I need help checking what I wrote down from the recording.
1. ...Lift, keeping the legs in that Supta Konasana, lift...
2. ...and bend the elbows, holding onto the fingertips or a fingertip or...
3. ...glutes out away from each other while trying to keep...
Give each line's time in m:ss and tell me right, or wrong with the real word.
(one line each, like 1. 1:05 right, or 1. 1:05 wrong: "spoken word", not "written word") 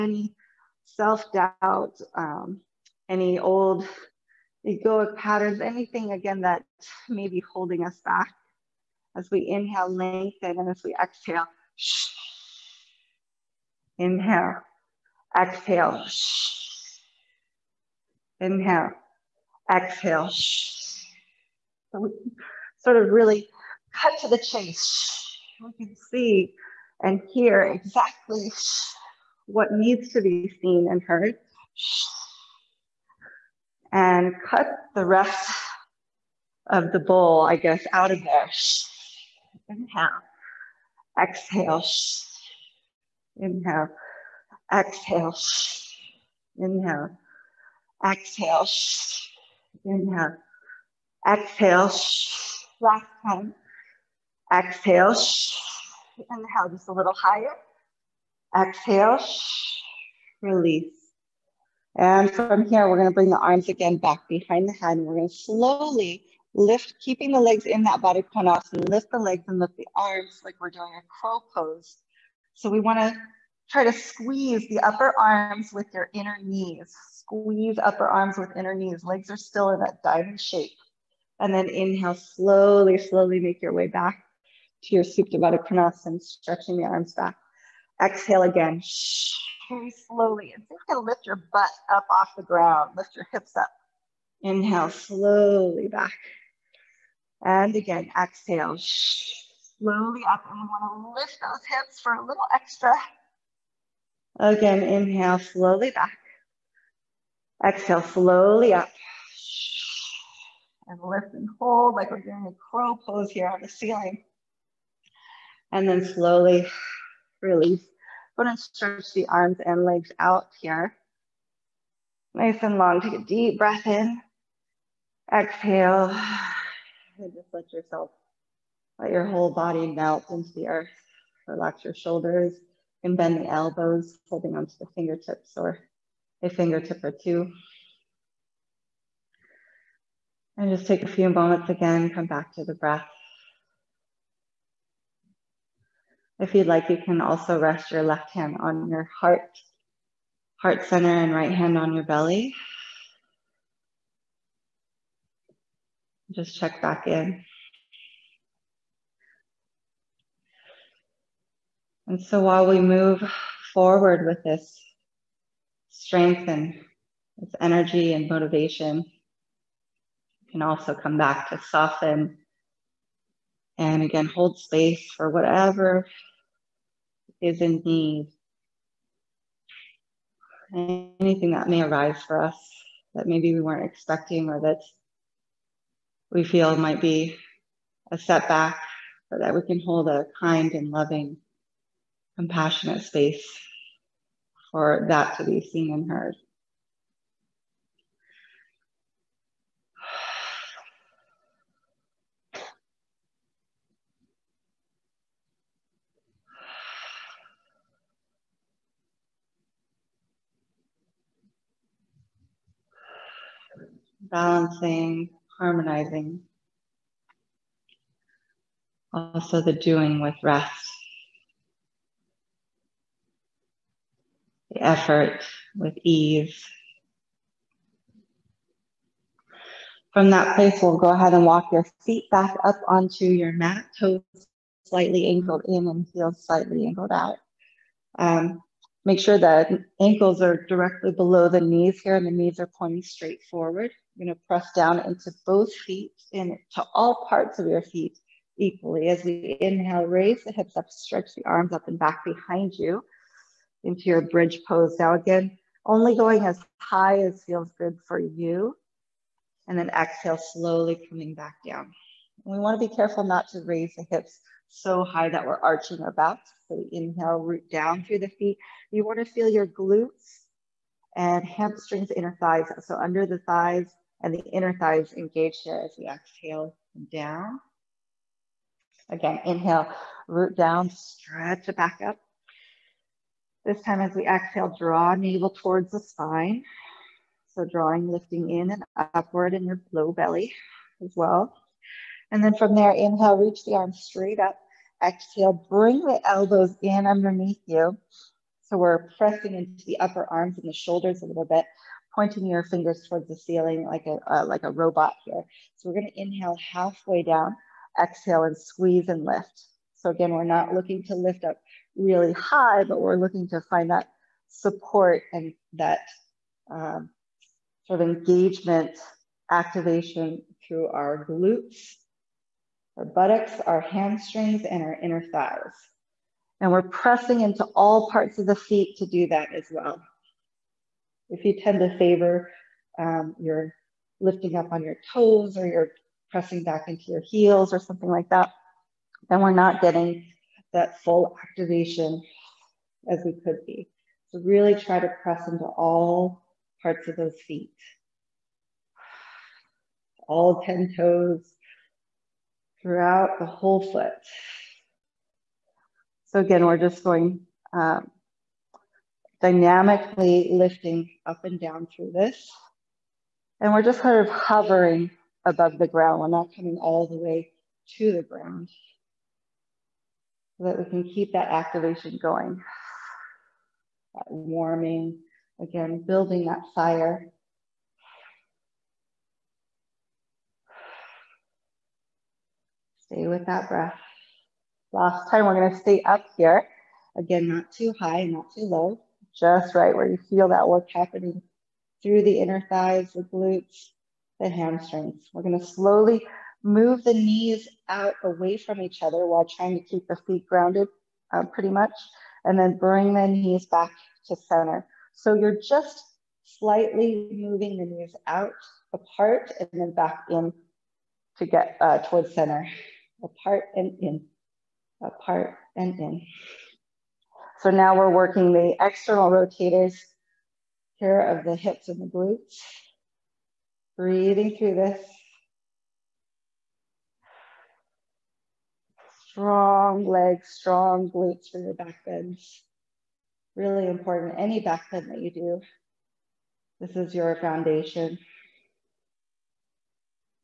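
1. 1:06 wrong: "Baddha", not "Supta"
2. 2:13 right
3. 6:37 wrong: "knees", not "glutes".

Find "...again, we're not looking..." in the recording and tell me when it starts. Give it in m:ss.
5:10.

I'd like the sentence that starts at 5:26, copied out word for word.
And we're pressing into all parts of the feet to do that as well.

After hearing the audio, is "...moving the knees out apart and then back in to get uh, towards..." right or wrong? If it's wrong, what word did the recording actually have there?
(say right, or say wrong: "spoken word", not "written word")
right.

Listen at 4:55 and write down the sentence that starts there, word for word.
Exhale, bring the elbows in underneath you.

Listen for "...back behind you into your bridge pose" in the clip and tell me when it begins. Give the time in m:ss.
4:11.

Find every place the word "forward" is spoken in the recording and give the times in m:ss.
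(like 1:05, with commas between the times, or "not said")
2:43, 4:03.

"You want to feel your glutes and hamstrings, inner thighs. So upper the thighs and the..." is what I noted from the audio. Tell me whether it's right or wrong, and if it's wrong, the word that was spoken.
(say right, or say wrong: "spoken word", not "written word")
wrong: "under", not "upper".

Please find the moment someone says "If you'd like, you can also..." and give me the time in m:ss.
2:26.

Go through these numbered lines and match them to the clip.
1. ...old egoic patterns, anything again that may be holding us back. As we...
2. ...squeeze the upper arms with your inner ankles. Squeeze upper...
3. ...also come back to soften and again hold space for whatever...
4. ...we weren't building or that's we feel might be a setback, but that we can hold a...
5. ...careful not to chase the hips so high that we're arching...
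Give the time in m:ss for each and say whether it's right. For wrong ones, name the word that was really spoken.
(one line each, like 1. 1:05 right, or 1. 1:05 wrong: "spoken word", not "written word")
1. 0:03 right
2. 1:13 wrong: "knees", not "ankles"
3. 2:50 right
4. 3:03 wrong: "expecting", not "building"
5. 4:22 wrong: "raise", not "chase".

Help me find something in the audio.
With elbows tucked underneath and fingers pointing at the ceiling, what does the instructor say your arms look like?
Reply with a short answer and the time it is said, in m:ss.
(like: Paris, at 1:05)
A robot, at 5:04.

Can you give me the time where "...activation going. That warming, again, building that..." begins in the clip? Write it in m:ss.
6:11.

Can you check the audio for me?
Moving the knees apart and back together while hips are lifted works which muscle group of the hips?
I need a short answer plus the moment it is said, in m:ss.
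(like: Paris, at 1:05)
External rotators, at 6:58.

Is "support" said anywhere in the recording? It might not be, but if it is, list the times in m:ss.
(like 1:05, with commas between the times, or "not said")
5:14.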